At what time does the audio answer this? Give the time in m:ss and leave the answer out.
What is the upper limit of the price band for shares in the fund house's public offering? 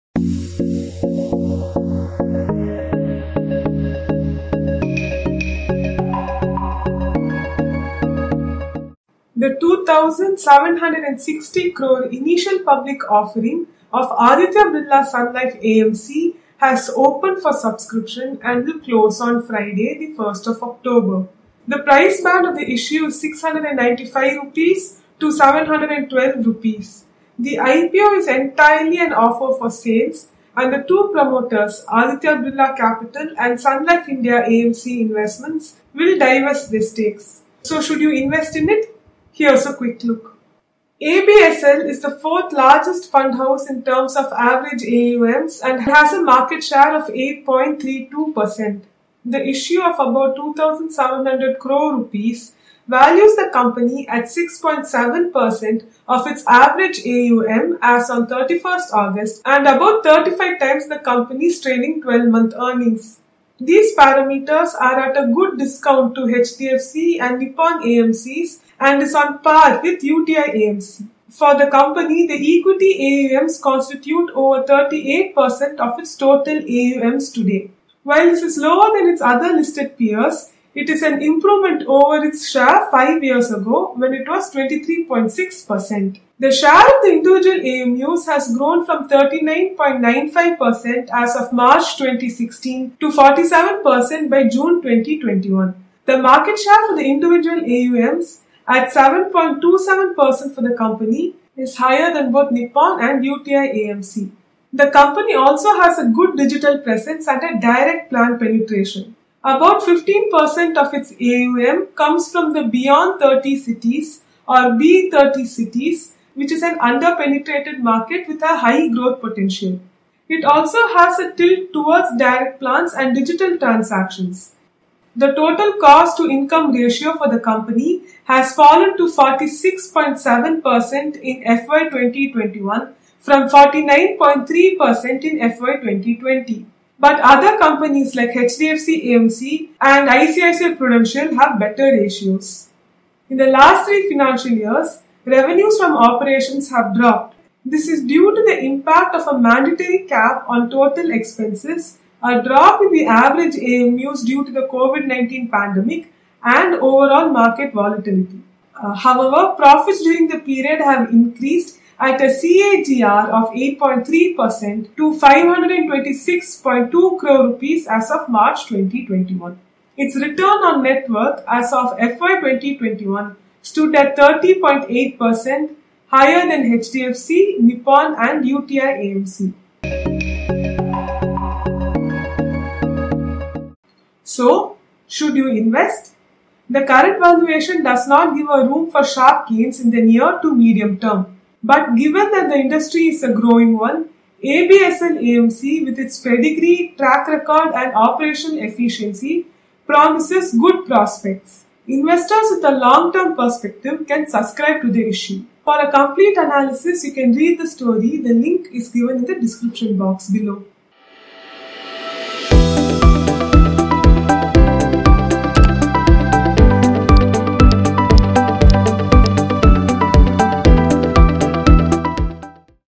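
0:25.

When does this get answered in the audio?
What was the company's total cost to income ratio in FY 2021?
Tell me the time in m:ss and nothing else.
2:09.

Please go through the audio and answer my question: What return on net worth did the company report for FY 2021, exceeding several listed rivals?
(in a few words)
30.8%.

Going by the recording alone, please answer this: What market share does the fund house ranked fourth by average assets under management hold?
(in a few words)
8.32%.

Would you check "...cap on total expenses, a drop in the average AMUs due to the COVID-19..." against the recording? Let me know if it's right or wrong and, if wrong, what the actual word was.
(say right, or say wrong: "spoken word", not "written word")
right.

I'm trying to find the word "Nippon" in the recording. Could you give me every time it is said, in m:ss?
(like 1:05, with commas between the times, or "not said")
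1:07, 1:42, 2:57.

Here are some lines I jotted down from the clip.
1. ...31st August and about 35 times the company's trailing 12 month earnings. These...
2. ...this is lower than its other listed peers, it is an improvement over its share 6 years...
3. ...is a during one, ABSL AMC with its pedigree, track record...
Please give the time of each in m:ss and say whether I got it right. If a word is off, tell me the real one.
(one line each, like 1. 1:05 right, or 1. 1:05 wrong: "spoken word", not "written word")
1. 0:58 right
2. 1:18 wrong: "5", not "6"
3. 3:13 wrong: "growing", not "during".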